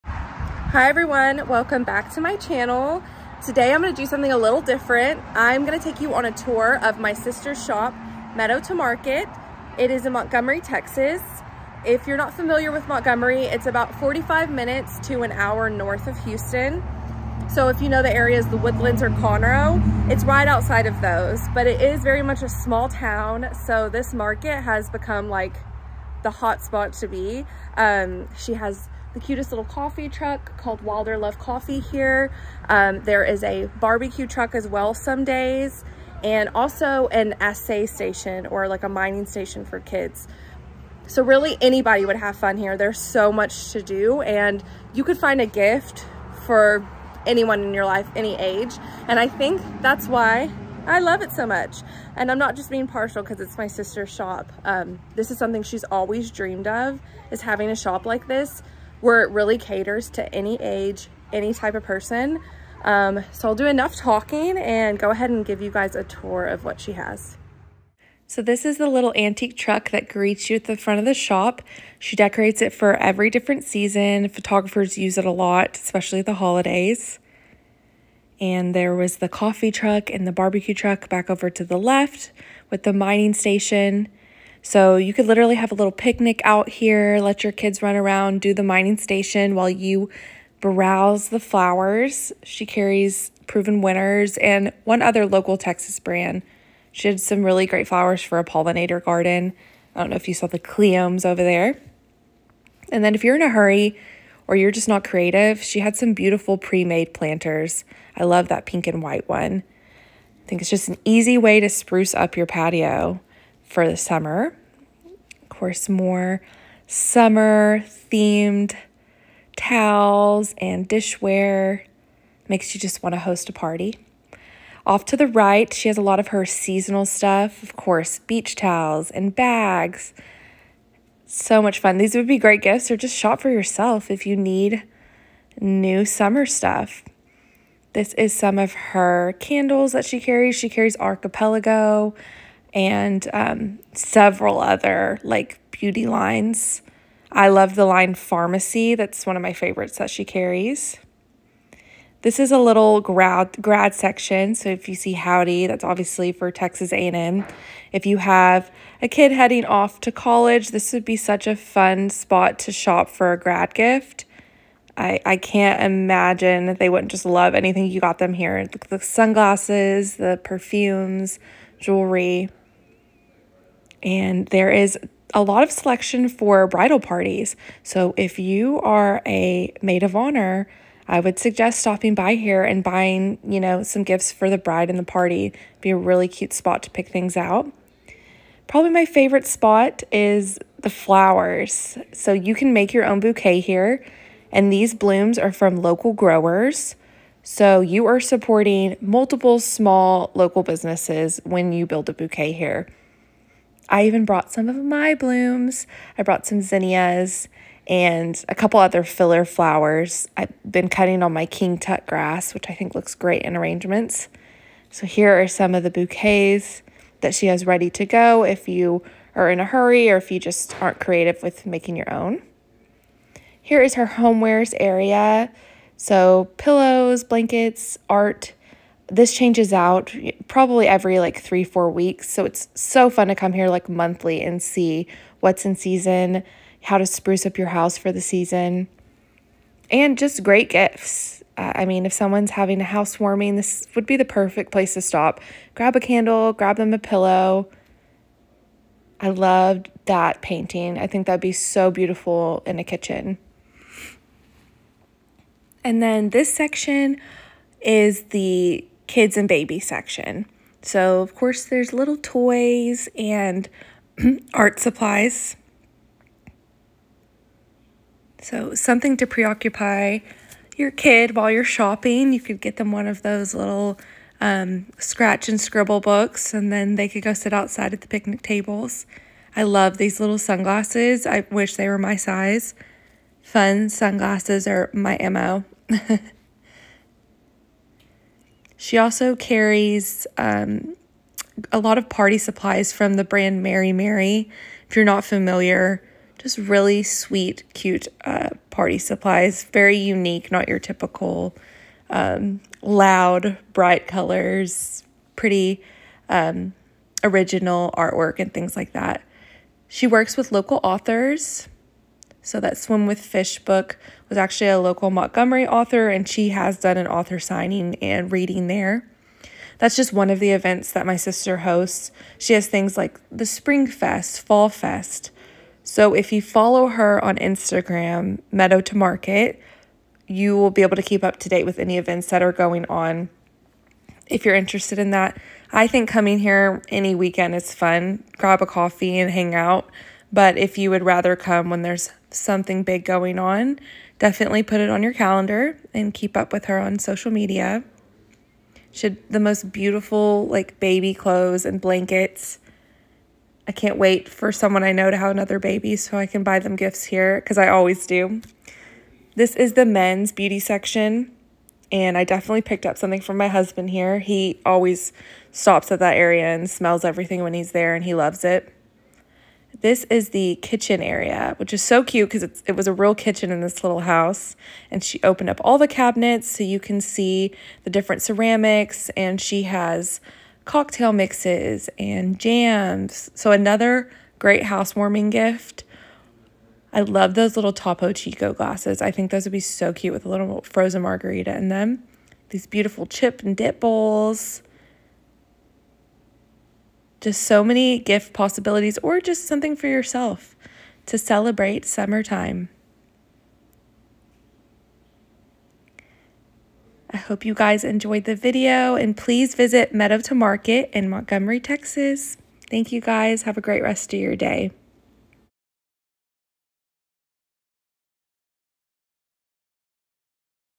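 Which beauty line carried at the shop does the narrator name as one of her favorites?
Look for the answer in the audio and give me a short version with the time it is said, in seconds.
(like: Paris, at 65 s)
Farmacy, at 148 s.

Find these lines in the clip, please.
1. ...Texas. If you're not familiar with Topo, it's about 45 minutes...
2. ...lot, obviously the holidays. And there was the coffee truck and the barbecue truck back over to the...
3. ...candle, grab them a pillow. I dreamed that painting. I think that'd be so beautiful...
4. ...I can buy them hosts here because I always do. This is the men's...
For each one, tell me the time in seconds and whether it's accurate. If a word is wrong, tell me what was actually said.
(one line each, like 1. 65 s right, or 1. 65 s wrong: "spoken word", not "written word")
1. 10 s wrong: "Montgomery", not "Topo"
2. 75 s wrong: "especially", not "obviously"
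3. 245 s wrong: "loved", not "dreamed"
4. 356 s wrong: "gifts", not "hosts".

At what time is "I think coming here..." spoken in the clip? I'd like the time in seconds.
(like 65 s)
335 s.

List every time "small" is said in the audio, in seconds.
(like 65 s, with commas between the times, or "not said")
22 s, 199 s.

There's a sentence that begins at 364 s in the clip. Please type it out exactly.
He always stops at that area and smells everything when he's there, and he loves it.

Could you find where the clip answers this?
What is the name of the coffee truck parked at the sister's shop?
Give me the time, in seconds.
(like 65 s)
30 s.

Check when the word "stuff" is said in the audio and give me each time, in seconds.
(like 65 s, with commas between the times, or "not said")
127 s, 136 s.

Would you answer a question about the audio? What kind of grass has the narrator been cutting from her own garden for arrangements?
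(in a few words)
King tut grass.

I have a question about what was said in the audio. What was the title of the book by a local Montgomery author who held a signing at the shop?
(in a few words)
Swim with Fish.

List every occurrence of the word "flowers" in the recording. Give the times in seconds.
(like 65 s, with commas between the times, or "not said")
91 s, 97 s, 190 s, 209 s.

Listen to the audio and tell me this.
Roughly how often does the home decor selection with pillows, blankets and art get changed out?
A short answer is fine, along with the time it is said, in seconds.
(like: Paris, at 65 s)
Every 3-4 weeks, at 230 s.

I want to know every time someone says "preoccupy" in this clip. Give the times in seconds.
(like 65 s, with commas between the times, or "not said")
269 s.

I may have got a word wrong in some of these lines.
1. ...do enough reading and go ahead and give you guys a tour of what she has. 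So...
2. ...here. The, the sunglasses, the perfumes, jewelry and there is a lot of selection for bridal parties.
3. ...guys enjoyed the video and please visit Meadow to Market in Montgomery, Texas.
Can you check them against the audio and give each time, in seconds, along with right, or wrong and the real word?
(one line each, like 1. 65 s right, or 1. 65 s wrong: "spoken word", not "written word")
1. 63 s wrong: "talking", not "reading"
2. 168 s right
3. 407 s right.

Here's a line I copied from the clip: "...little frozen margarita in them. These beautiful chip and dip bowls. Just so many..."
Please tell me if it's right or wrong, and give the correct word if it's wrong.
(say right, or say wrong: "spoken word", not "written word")
right.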